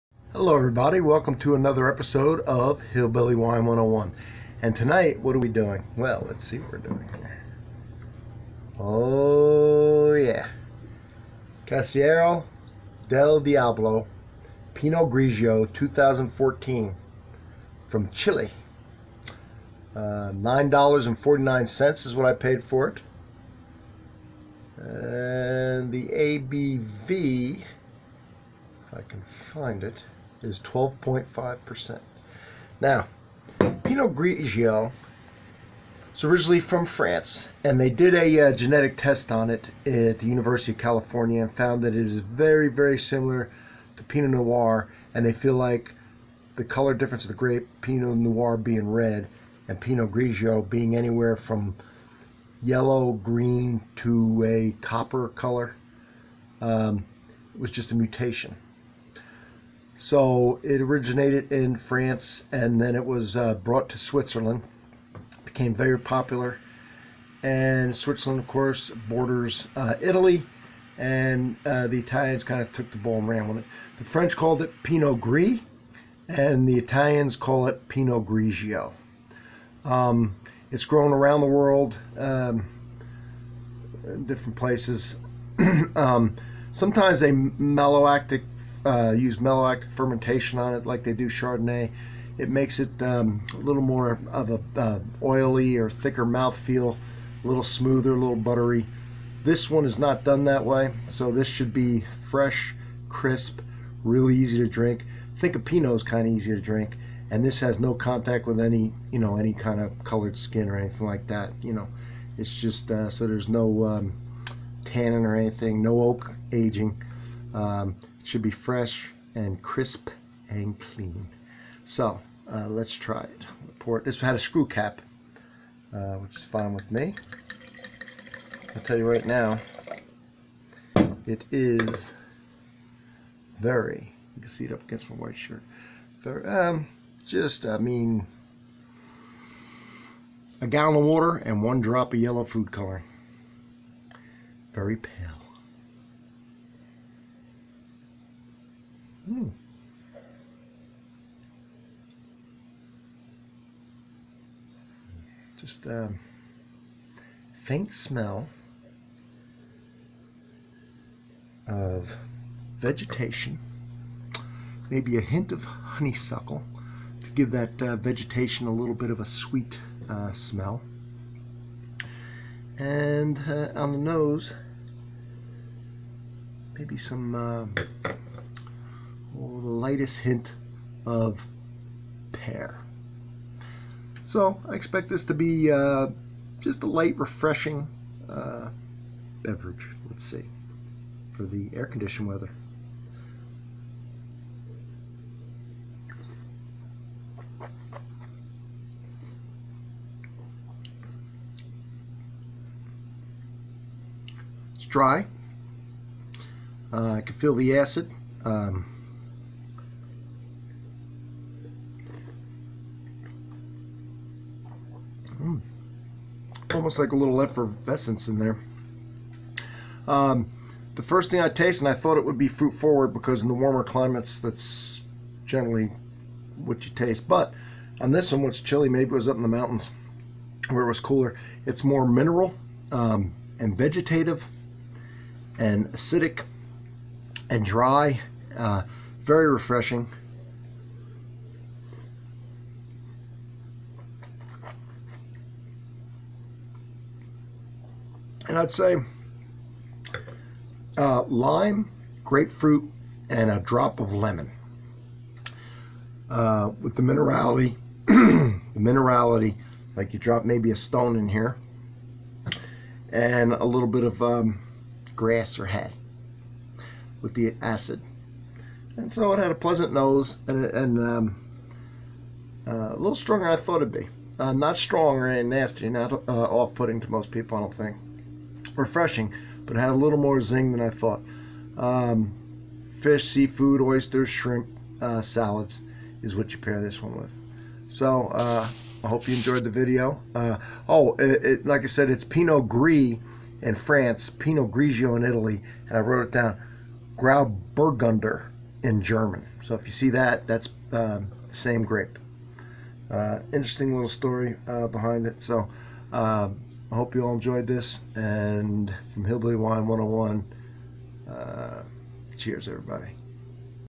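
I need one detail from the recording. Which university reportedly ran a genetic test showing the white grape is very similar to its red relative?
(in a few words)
University of California.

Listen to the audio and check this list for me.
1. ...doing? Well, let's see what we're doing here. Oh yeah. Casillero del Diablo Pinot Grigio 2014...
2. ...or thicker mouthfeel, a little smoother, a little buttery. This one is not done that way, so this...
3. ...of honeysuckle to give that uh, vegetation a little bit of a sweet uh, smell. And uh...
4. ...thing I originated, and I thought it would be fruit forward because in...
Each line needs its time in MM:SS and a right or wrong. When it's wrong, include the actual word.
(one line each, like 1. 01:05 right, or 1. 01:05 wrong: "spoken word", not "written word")
1. 00:05 right
2. 01:35 right
3. 02:45 right
4. 03:41 wrong: "tasted", not "originated".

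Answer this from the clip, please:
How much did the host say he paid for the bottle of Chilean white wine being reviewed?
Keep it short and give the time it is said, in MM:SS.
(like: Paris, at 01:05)
$9.49, at 00:20.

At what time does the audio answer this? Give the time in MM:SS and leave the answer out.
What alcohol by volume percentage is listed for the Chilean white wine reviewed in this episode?
00:30.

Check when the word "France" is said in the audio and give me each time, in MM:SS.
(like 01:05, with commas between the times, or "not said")
00:36, 01:01, 04:53.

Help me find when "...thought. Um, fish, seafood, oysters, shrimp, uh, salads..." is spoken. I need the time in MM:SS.
04:40.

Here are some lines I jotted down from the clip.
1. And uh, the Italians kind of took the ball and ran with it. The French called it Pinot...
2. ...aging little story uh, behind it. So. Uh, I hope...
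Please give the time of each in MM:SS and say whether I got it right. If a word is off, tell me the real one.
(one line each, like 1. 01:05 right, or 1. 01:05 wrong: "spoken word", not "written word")
1. 01:10 right
2. 05:03 wrong: "interesting", not "aging".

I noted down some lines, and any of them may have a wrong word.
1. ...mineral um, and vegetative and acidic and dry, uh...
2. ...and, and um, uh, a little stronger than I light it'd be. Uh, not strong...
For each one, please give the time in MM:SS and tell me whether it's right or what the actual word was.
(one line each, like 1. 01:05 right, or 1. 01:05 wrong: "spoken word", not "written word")
1. 03:52 right
2. 04:30 wrong: "thought", not "light".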